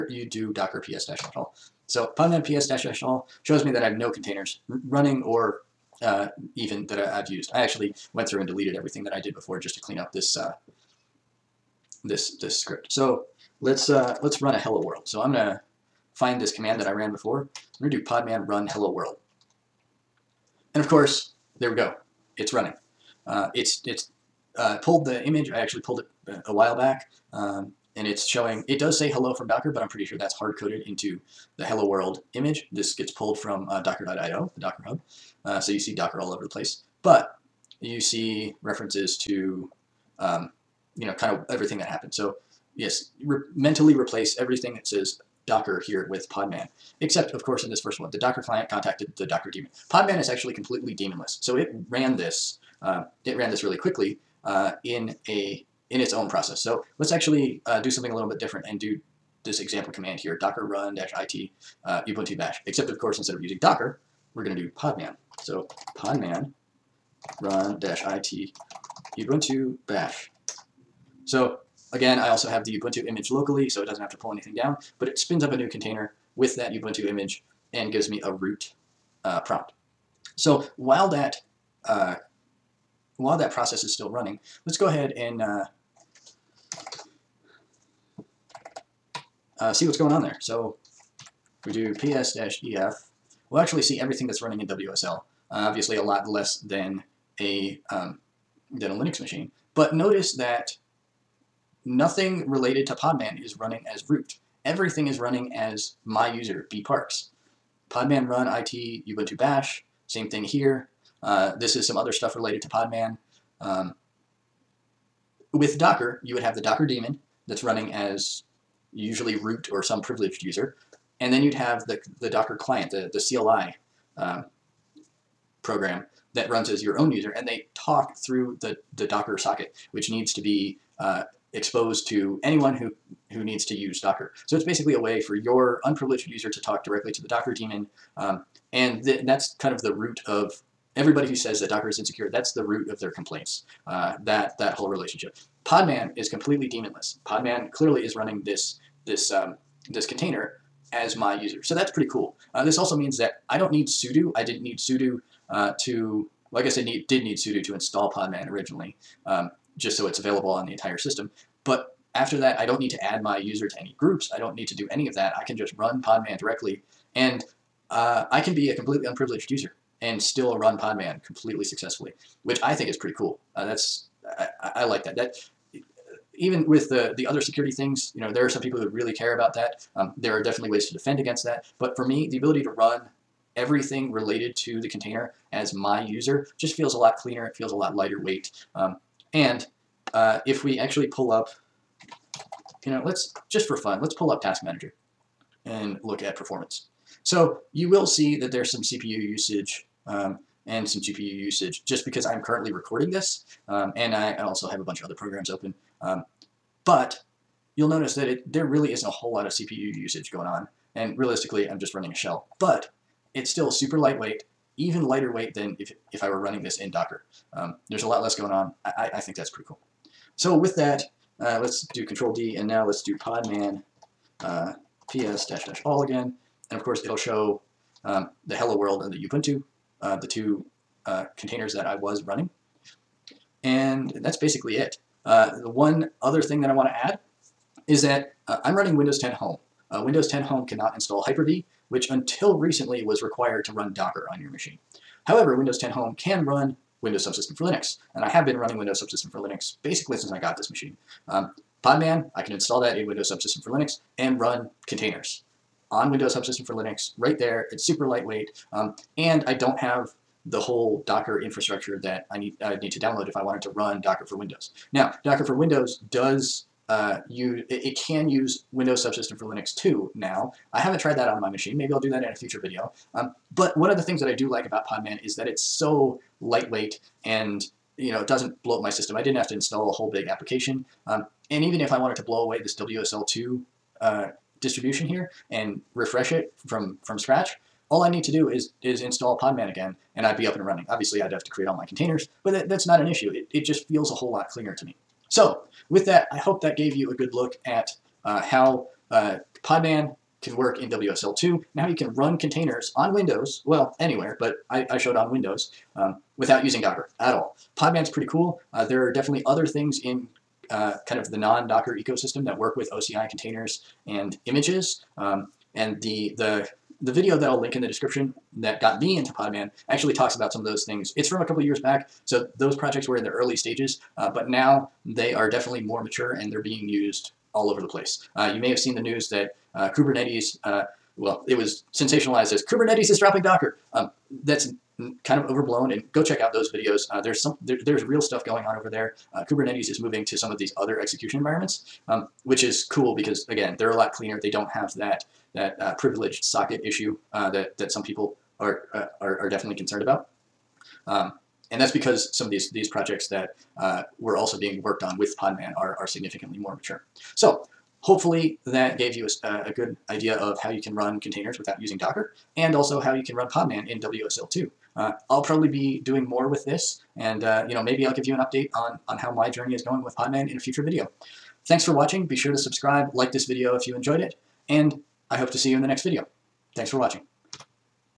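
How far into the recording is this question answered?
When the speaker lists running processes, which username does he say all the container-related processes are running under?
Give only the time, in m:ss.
1:46.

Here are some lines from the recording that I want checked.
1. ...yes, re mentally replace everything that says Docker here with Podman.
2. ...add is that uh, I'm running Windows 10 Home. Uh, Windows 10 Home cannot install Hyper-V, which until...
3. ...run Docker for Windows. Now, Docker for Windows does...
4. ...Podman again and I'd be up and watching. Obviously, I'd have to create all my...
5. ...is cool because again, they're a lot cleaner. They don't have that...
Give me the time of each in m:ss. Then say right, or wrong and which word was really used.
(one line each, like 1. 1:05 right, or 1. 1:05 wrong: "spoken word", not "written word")
1. 0:42 right
2. 3:57 right
3. 4:23 right
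4. 4:49 wrong: "running", not "watching"
5. 5:42 right.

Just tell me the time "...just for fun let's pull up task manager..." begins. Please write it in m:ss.
3:13.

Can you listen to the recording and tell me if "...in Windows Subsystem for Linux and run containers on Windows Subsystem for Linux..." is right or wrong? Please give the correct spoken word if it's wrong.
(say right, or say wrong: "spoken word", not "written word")
right.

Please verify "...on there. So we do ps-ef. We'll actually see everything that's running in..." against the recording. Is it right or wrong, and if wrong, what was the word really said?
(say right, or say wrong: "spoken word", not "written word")
right.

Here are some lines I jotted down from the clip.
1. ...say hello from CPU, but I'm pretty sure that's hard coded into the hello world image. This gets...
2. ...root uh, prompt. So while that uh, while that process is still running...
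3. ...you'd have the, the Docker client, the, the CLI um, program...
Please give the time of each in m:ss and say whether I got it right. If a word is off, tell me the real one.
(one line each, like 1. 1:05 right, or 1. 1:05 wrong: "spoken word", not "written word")
1. 0:28 wrong: "Docker", not "CPU"
2. 1:18 right
3. 2:01 right.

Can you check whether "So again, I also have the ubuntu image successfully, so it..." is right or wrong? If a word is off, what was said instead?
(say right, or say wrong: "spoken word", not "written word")
wrong: "locally", not "successfully".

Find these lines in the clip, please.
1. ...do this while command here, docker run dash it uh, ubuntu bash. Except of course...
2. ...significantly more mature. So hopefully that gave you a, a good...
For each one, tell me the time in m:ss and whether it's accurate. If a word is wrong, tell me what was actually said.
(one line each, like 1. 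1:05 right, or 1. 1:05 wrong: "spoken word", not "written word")
1. 0:58 wrong: "example", not "while"
2. 5:56 right.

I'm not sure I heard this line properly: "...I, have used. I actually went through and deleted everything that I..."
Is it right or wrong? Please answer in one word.
right.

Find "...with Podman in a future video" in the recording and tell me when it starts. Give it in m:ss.
6:10.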